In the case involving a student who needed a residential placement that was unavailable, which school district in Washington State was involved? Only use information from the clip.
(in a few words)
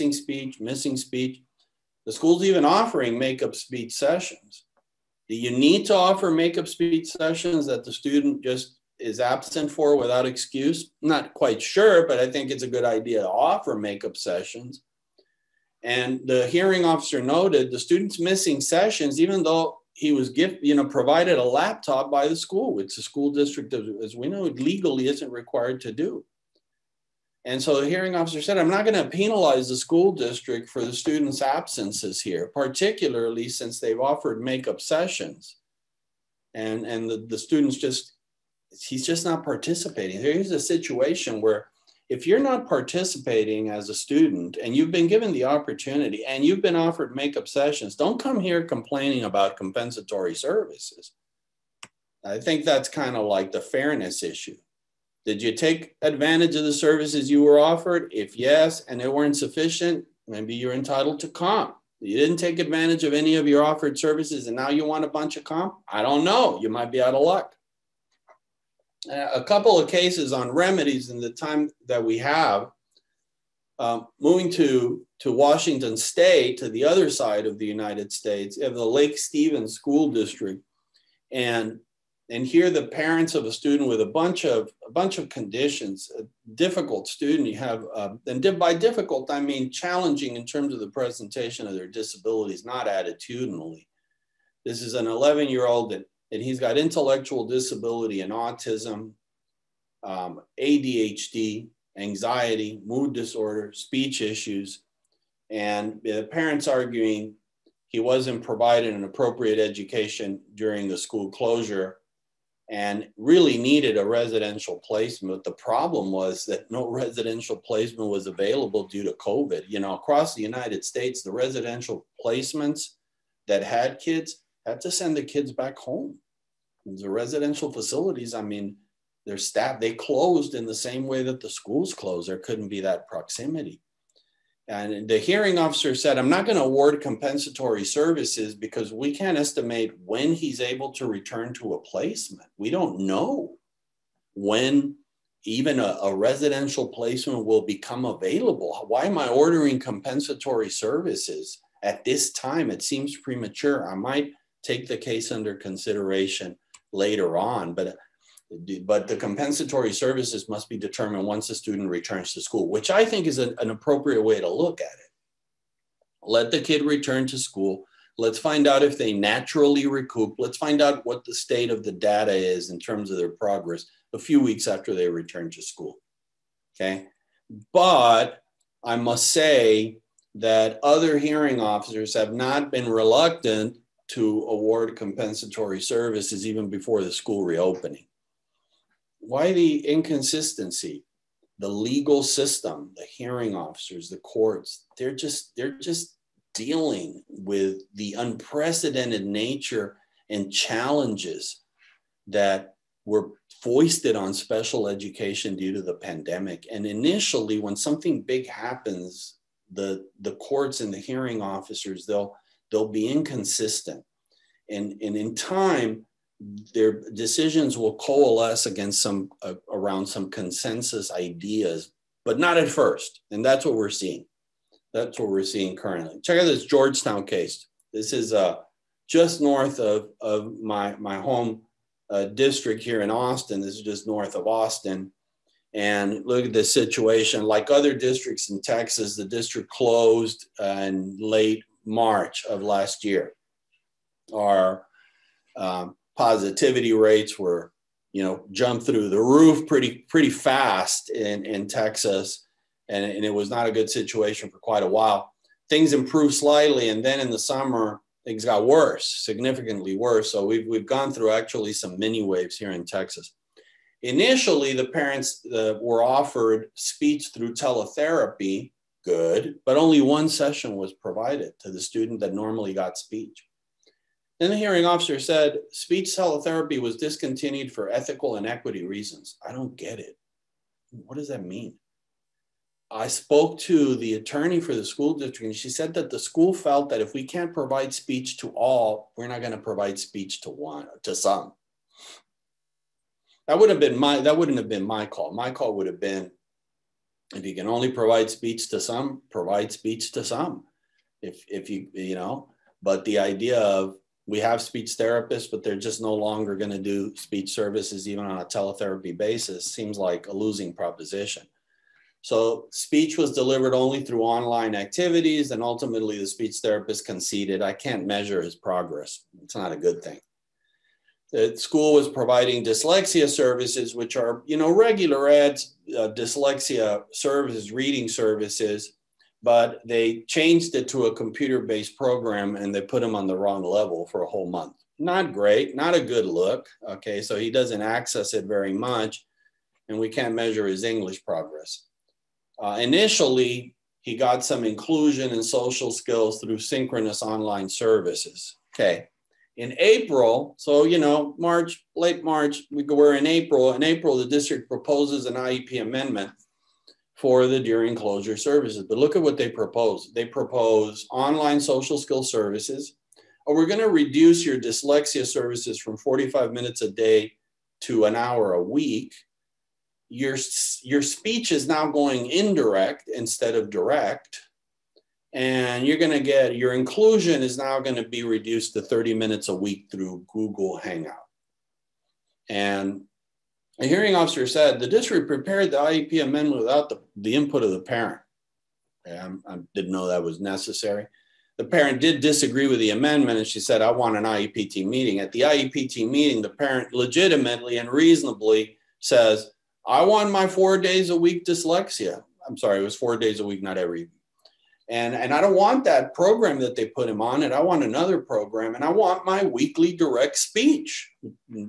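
Lake Stevens School District.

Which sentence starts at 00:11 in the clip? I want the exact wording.
Not quite sure, but I think it's a good idea to offer makeup sessions.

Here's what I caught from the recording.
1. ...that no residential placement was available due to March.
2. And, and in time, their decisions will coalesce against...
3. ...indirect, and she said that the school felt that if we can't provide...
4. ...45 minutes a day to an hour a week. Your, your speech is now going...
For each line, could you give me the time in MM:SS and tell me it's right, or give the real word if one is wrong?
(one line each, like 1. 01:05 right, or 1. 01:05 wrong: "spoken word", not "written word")
1. 01:56 wrong: "COVID", not "March"
2. 03:34 right
3. 04:45 wrong: "district", not "indirect"
4. 06:05 right.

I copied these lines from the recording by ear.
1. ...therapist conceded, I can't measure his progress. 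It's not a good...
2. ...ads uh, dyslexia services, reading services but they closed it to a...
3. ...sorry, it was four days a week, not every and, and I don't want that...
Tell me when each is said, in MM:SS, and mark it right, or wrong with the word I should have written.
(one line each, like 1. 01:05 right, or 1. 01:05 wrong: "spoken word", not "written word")
1. 05:16 right
2. 05:25 wrong: "changed", not "closed"
3. 06:42 right.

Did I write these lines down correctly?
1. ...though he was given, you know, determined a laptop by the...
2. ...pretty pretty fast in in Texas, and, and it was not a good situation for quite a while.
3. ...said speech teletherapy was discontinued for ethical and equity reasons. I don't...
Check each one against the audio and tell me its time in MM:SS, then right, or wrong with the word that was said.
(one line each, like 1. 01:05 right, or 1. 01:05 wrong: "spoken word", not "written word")
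1. 00:19 wrong: "provided", not "determined"
2. 04:09 right
3. 04:35 right.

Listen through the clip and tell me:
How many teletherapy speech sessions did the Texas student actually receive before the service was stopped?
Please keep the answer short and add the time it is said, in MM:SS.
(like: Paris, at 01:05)
1, at 04:30.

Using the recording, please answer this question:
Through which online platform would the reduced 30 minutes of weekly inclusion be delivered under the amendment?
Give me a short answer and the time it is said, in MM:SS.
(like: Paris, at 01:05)
Google Hangout, at 06:20.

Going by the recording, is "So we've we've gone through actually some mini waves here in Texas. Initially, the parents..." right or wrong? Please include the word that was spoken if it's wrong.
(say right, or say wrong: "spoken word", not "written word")
right.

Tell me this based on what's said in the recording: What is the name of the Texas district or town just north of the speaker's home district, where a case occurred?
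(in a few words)
Georgetown.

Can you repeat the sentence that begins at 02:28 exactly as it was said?
Why am I ordering compensatory services at this time?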